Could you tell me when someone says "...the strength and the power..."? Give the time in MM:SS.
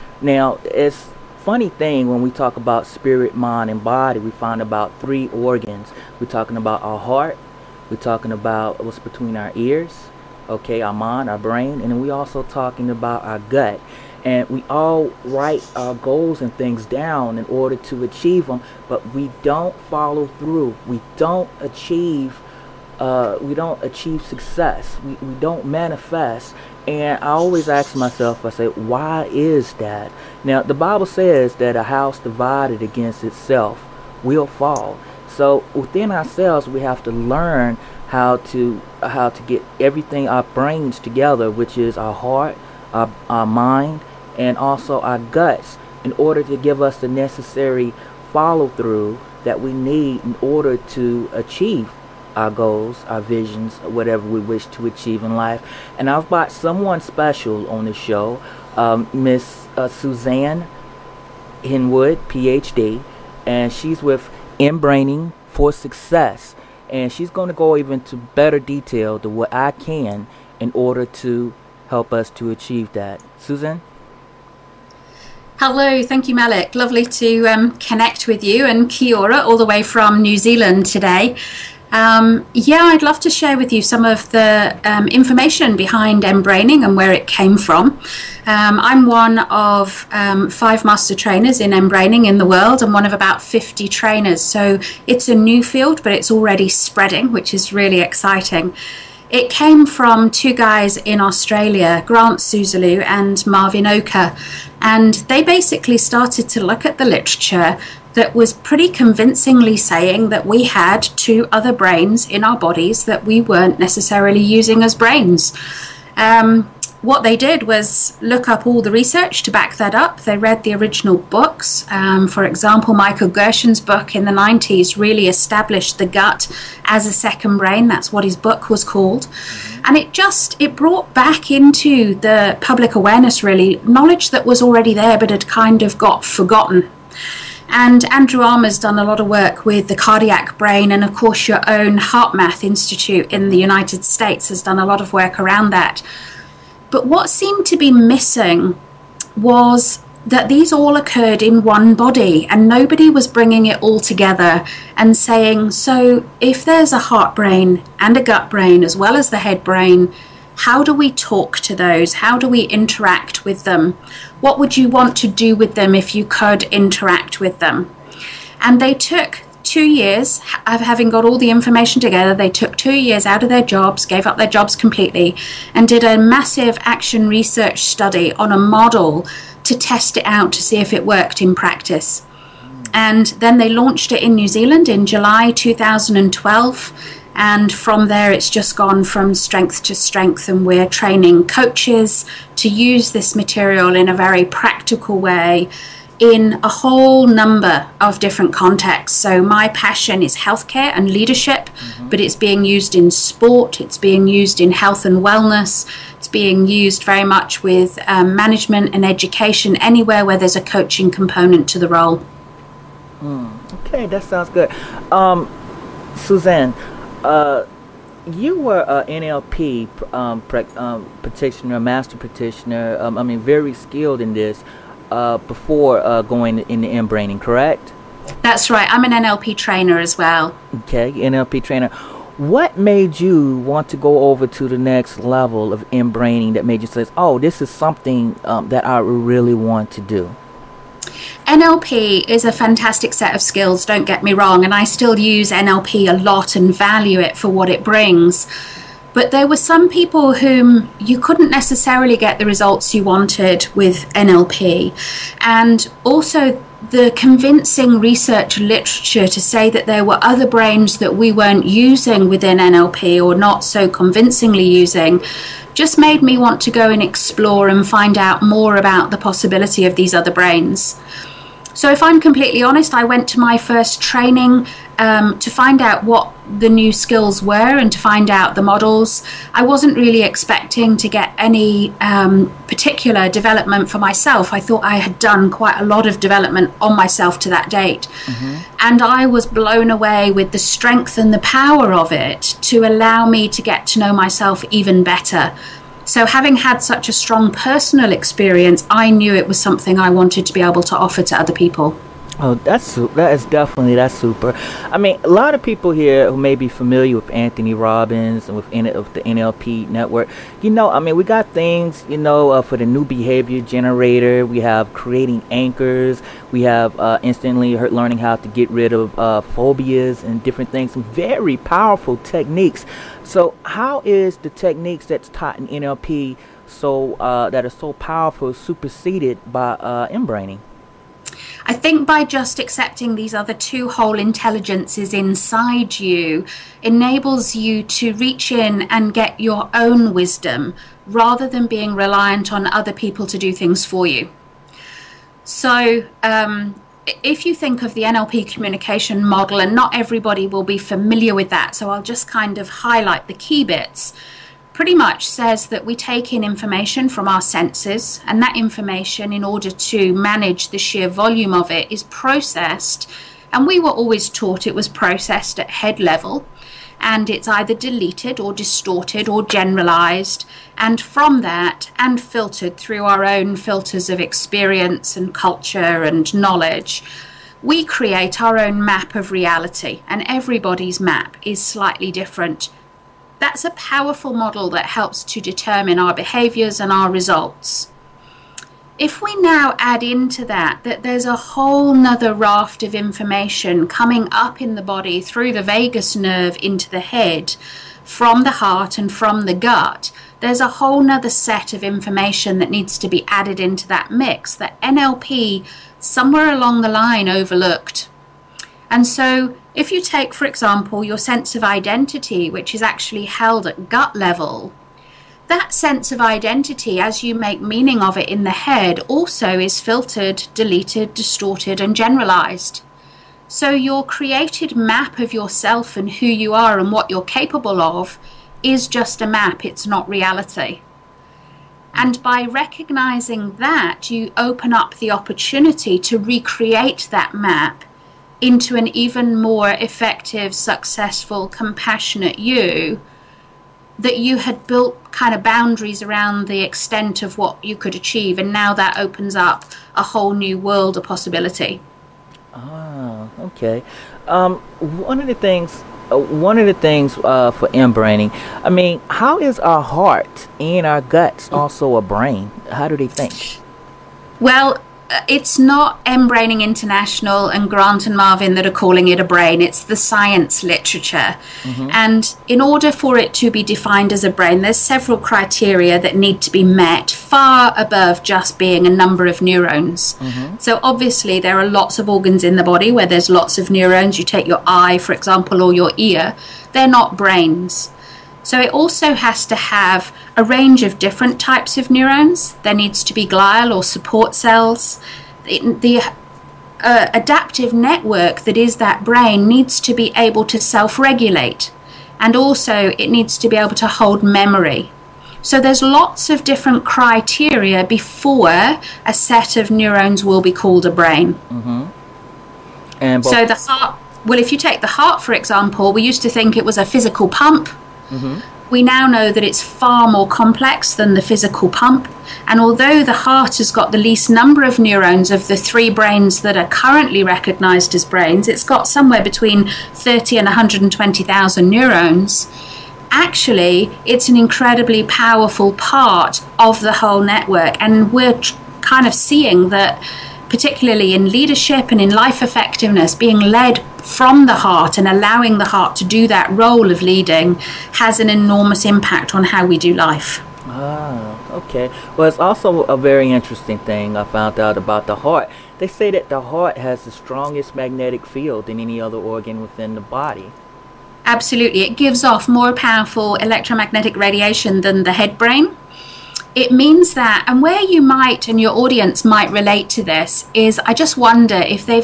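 04:50.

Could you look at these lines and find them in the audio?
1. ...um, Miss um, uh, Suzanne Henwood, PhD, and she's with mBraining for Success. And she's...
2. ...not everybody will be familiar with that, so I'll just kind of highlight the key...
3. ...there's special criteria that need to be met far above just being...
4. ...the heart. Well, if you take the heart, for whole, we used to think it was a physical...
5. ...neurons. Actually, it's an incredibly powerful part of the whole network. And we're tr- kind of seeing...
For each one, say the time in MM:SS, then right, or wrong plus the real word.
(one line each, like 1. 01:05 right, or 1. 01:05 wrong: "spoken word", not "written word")
1. 00:58 right
2. 05:49 right
3. 07:54 wrong: "several", not "special"
4. 08:33 wrong: "example", not "whole"
5. 08:51 right.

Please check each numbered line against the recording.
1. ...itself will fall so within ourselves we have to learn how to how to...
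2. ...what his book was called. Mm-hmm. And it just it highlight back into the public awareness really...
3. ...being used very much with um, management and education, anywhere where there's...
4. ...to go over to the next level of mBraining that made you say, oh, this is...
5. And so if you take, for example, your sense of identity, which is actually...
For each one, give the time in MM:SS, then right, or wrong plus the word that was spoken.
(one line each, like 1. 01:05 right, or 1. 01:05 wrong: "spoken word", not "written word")
1. 00:33 right
2. 02:08 wrong: "brought", not "highlight"
3. 03:26 right
4. 03:53 right
5. 06:48 right.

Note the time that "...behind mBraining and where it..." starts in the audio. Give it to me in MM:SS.
01:25.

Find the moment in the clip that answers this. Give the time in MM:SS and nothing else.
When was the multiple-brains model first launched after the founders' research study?
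03:05.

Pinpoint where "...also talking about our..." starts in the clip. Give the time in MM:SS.
00:12.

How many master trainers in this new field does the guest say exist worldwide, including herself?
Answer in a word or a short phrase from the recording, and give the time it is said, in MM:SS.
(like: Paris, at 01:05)
5, at 01:30.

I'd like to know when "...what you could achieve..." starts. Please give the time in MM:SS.
07:27.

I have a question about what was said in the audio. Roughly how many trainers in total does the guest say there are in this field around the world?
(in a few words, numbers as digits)
50.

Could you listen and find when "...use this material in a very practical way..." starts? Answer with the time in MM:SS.
03:12.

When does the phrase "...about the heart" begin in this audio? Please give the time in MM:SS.
09:14.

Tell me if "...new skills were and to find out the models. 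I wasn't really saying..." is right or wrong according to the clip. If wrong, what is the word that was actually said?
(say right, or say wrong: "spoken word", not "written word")
wrong: "expecting", not "saying".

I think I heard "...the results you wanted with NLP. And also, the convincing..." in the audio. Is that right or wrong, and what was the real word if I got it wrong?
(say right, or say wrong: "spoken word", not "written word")
right.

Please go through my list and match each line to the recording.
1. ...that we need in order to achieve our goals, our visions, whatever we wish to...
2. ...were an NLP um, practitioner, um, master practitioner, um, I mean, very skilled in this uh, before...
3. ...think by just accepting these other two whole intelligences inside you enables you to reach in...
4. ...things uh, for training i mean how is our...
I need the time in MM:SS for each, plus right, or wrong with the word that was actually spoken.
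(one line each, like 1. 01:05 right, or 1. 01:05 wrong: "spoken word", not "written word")
1. 00:49 right
2. 03:38 right
3. 05:31 right
4. 07:36 wrong: "mBraining", not "training".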